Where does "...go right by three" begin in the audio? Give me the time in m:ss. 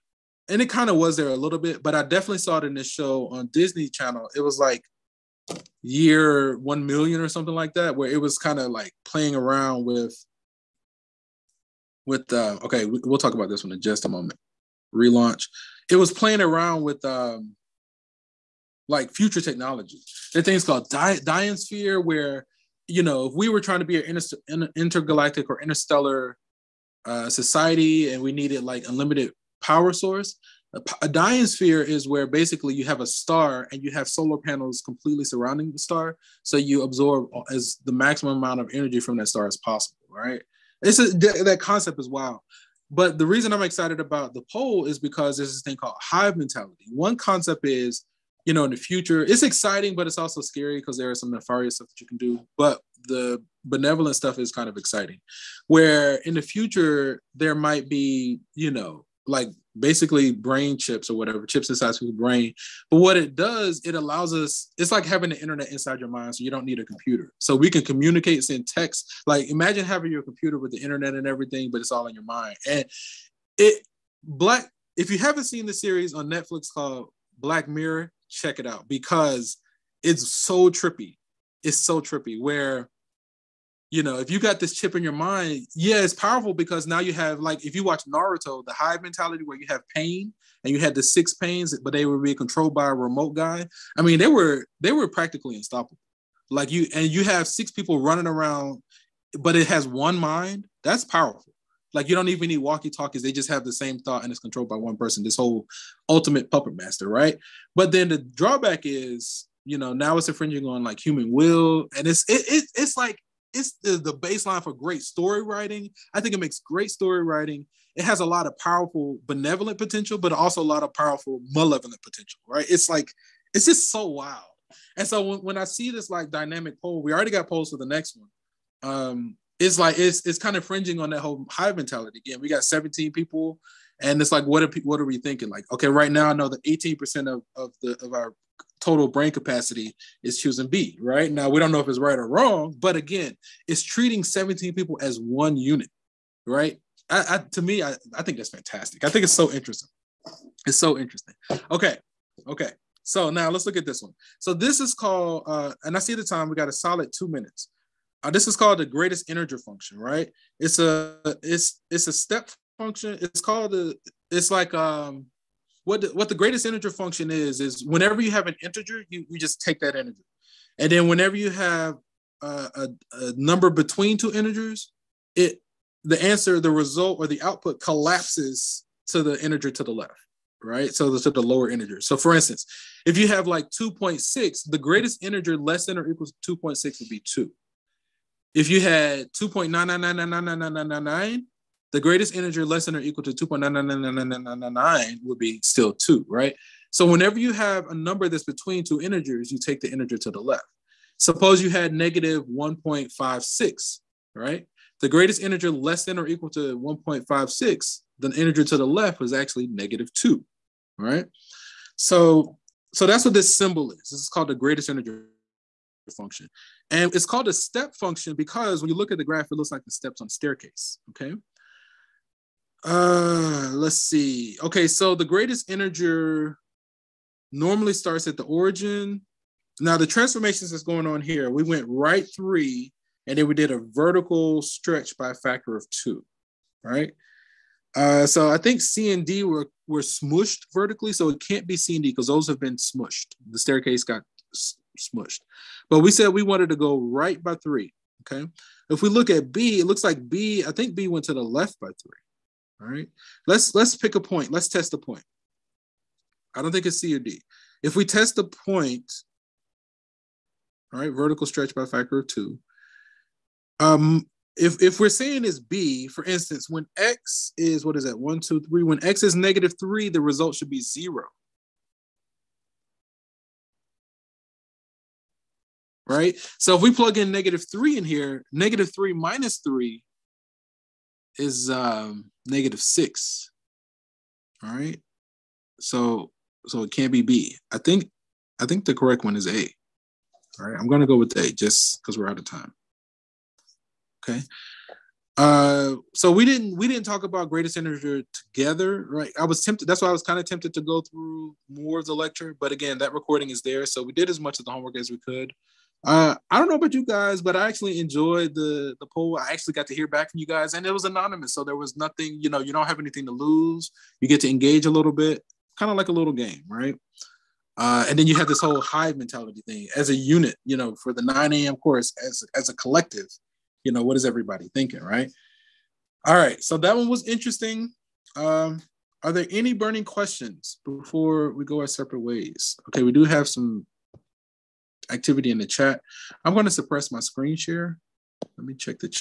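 4:06.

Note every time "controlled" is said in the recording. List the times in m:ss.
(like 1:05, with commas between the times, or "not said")
1:32, 1:44.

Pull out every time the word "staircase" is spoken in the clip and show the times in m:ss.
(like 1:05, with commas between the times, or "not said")
3:40, 4:03.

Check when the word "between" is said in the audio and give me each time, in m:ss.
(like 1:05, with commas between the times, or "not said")
2:53, 3:18.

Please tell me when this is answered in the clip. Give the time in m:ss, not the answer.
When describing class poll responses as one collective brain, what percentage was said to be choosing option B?
2:16.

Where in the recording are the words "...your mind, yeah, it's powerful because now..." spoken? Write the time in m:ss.
1:25.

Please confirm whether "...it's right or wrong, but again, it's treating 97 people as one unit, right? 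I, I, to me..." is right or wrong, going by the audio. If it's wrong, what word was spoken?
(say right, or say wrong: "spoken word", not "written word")
wrong: "17", not "97".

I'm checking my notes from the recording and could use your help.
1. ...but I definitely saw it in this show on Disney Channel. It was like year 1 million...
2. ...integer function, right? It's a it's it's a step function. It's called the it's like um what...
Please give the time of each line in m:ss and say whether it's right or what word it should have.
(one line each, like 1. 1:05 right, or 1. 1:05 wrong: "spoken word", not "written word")
1. 0:01 right
2. 2:39 right.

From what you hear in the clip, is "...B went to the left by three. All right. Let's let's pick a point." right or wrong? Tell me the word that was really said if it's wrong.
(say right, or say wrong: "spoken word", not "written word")
right.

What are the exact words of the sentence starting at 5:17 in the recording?
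Uh, and then you have this whole hive mentality thing as a unit.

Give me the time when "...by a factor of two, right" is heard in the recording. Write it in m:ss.
3:55.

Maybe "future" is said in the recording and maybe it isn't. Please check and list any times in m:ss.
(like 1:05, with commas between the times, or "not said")
0:19, 0:48, 0:56.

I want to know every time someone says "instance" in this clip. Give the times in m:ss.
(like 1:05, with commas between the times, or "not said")
3:02, 4:26.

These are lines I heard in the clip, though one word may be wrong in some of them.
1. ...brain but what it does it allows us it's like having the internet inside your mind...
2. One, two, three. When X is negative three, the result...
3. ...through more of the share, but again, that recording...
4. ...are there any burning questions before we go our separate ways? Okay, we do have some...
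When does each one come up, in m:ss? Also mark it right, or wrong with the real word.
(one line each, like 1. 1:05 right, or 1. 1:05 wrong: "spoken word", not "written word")
1. 1:02 right
2. 4:28 right
3. 5:01 wrong: "lecture", not "share"
4. 5:29 right.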